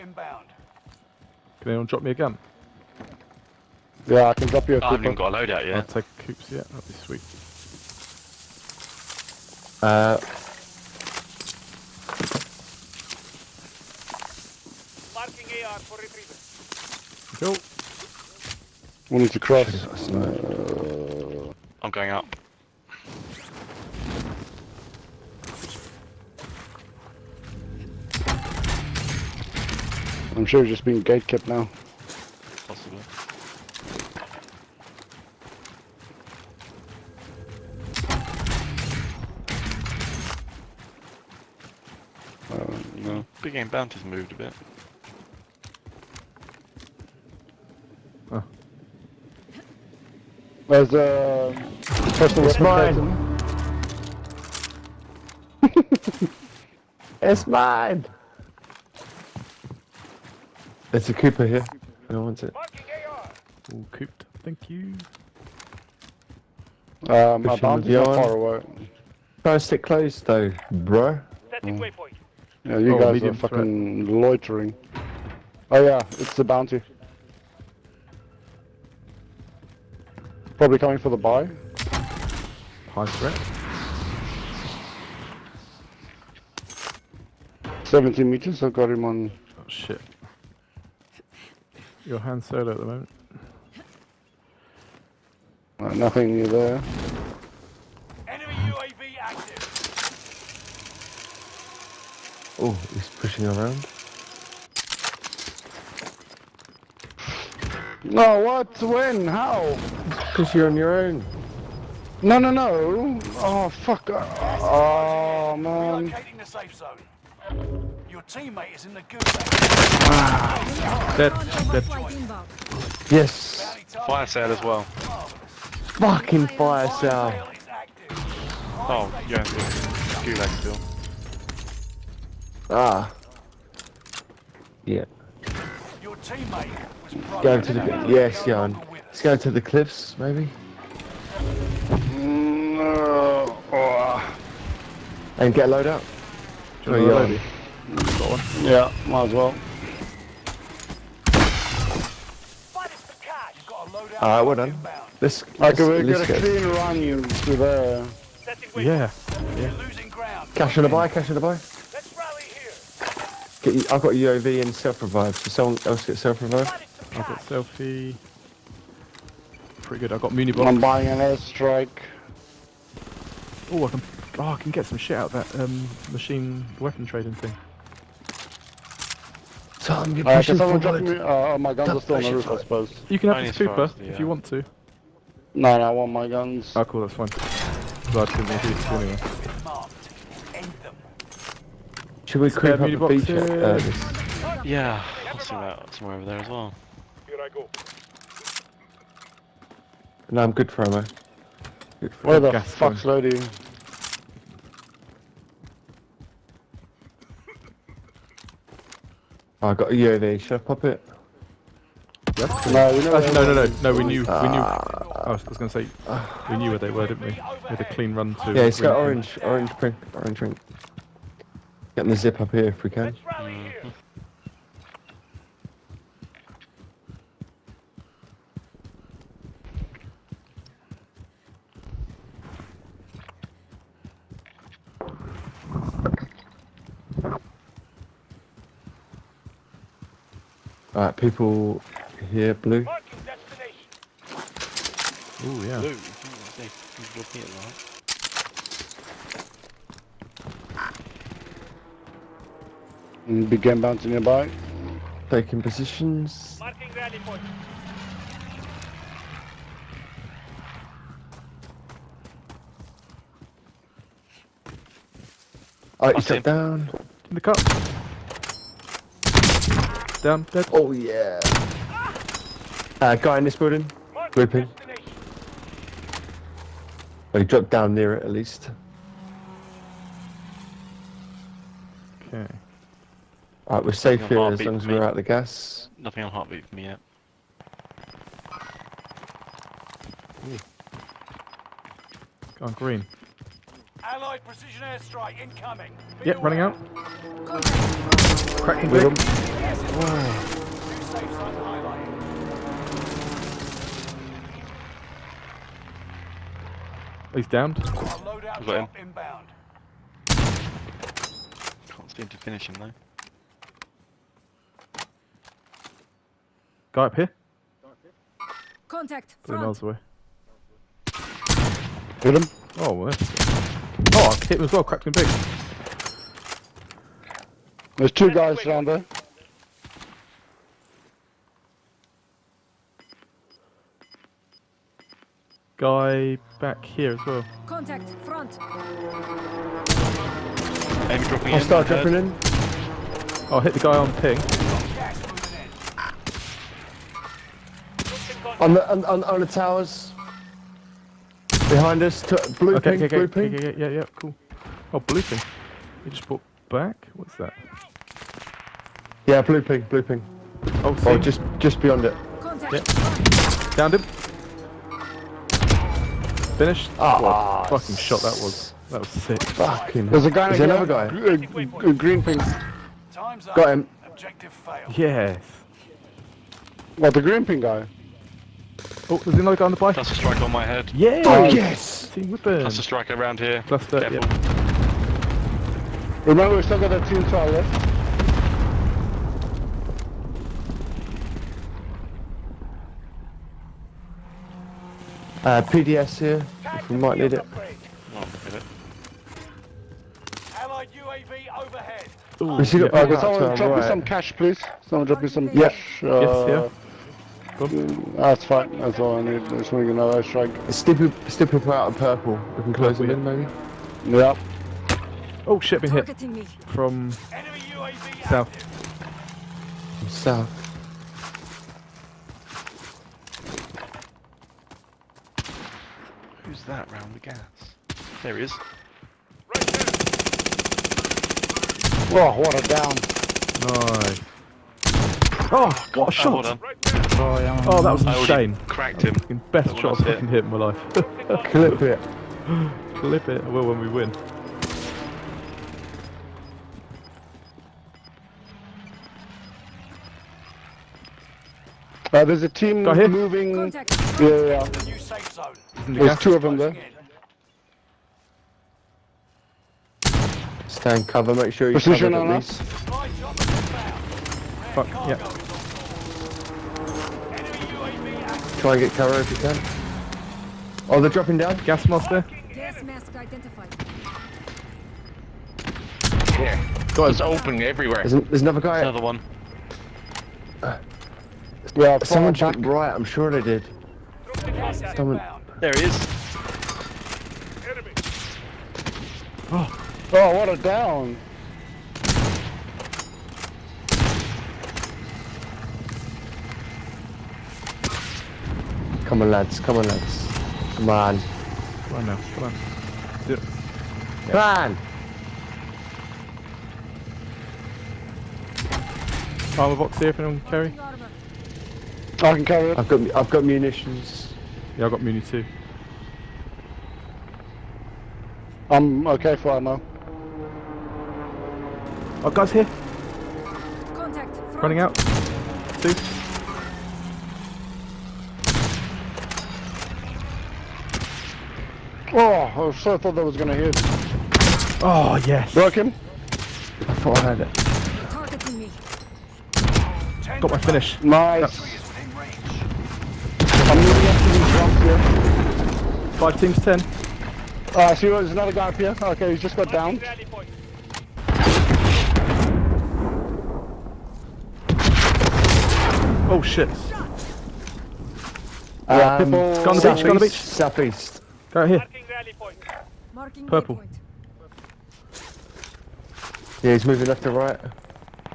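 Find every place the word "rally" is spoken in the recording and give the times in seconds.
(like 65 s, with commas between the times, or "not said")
162 s, 256 s.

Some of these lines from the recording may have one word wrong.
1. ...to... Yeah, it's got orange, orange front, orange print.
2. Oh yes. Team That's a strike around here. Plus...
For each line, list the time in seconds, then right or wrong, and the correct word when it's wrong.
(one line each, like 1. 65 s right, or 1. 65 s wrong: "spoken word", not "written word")
1. 218 s wrong: "print", not "front"
2. 381 s right.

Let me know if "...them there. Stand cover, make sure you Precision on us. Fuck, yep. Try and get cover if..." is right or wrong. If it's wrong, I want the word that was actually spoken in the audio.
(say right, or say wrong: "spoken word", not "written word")
right.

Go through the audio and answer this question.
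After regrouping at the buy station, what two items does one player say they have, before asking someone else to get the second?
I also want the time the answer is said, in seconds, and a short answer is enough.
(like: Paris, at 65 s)
UAV and self-revive, at 164 s.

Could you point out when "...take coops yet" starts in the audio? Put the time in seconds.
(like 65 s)
5 s.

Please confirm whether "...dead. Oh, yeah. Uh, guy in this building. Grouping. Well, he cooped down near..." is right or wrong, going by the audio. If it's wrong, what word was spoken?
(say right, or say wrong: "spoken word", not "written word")
wrong: "dropped", not "cooped".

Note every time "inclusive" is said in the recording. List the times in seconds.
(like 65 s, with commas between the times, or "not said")
not said.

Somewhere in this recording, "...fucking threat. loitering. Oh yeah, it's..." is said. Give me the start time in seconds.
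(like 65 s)
73 s.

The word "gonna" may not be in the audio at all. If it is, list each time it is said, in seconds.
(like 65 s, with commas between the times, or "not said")
215 s, 533 s.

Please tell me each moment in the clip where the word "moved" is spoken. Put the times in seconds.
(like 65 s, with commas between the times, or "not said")
44 s.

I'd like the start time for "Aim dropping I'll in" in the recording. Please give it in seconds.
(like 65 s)
341 s.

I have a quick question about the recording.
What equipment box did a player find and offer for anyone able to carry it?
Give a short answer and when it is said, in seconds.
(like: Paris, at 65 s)
Armor box, at 509 s.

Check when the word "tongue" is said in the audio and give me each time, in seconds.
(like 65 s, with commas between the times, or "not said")
not said.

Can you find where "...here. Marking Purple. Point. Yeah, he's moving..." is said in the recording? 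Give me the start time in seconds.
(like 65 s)
561 s.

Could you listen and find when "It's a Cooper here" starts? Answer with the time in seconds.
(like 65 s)
60 s.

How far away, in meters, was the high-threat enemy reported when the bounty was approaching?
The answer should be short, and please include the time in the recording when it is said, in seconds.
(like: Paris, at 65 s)
17, at 87 s.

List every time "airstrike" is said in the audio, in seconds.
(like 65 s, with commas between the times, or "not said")
171 s, 294 s.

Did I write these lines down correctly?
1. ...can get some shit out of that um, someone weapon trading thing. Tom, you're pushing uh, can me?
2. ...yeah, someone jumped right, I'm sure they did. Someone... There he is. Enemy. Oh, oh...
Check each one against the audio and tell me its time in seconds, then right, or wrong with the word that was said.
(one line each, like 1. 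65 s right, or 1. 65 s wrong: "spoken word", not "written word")
1. 174 s wrong: "machine", not "someone"
2. 481 s right.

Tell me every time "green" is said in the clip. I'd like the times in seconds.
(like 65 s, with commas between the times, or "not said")
292 s, 371 s, 377 s.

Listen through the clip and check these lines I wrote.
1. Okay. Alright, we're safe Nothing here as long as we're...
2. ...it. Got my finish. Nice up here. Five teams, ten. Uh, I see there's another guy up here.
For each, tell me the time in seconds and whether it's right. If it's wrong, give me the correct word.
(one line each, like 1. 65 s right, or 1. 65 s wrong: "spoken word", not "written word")
1. 282 s right
2. 537 s right.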